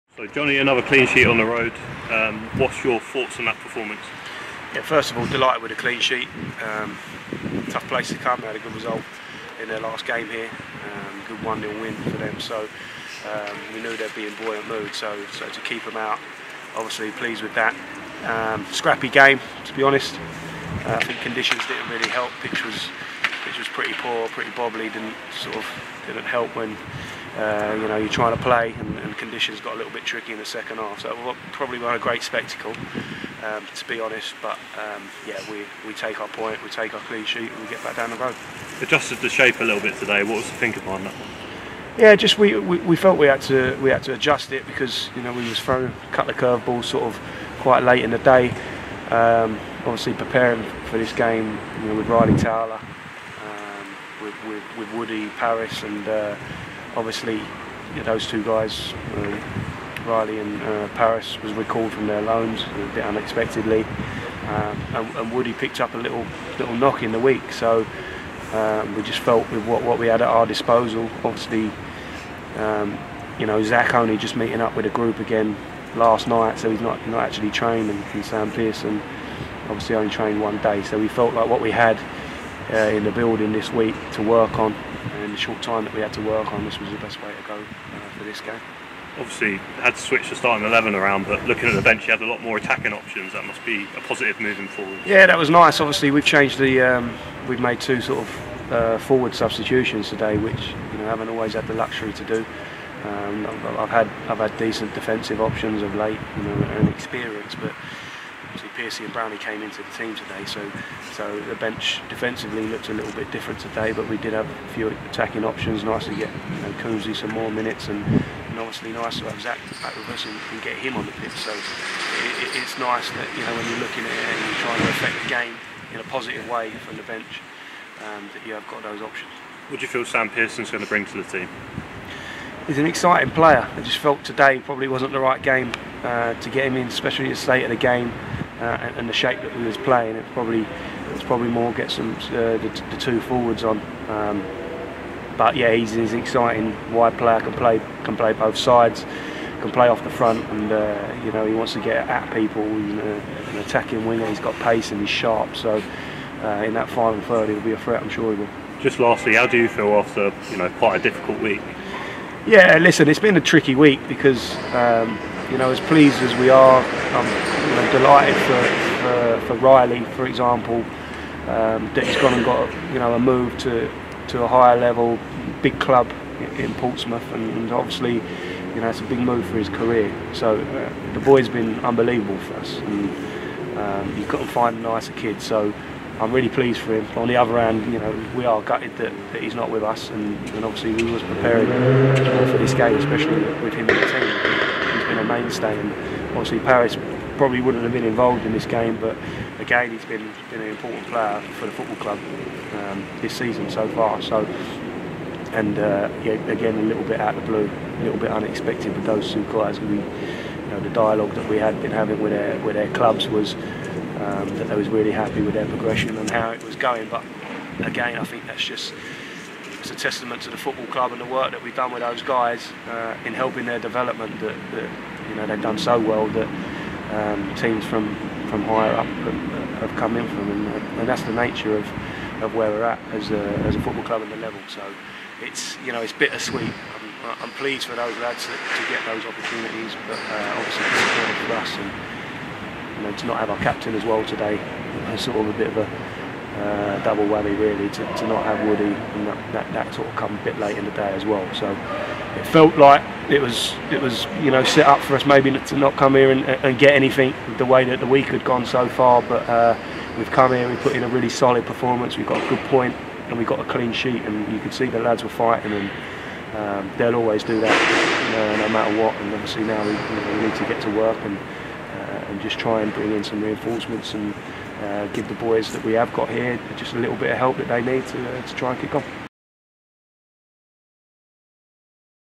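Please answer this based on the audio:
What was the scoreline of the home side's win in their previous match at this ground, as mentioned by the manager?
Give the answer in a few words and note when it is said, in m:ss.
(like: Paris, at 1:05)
1-0, at 0:11.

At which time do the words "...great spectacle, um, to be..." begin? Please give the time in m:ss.
0:31.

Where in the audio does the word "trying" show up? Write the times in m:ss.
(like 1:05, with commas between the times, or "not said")
0:28, 2:04.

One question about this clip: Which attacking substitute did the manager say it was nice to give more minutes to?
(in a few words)
Coonsley.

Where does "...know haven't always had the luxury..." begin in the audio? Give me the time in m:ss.
1:40.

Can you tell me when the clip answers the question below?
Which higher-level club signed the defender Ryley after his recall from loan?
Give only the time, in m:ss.
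2:56.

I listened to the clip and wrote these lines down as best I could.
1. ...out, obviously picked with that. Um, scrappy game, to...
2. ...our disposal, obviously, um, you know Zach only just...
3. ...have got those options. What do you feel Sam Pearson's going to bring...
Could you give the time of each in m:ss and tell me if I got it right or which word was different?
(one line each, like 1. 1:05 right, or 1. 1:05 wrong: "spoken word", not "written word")
1. 0:15 wrong: "pleased", not "picked"
2. 1:10 right
3. 2:08 right.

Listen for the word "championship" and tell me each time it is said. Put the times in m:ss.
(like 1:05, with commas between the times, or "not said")
not said.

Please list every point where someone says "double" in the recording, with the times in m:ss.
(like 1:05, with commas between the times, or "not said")
4:07.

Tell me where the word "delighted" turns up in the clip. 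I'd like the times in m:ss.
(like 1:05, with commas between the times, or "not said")
0:05, 2:47.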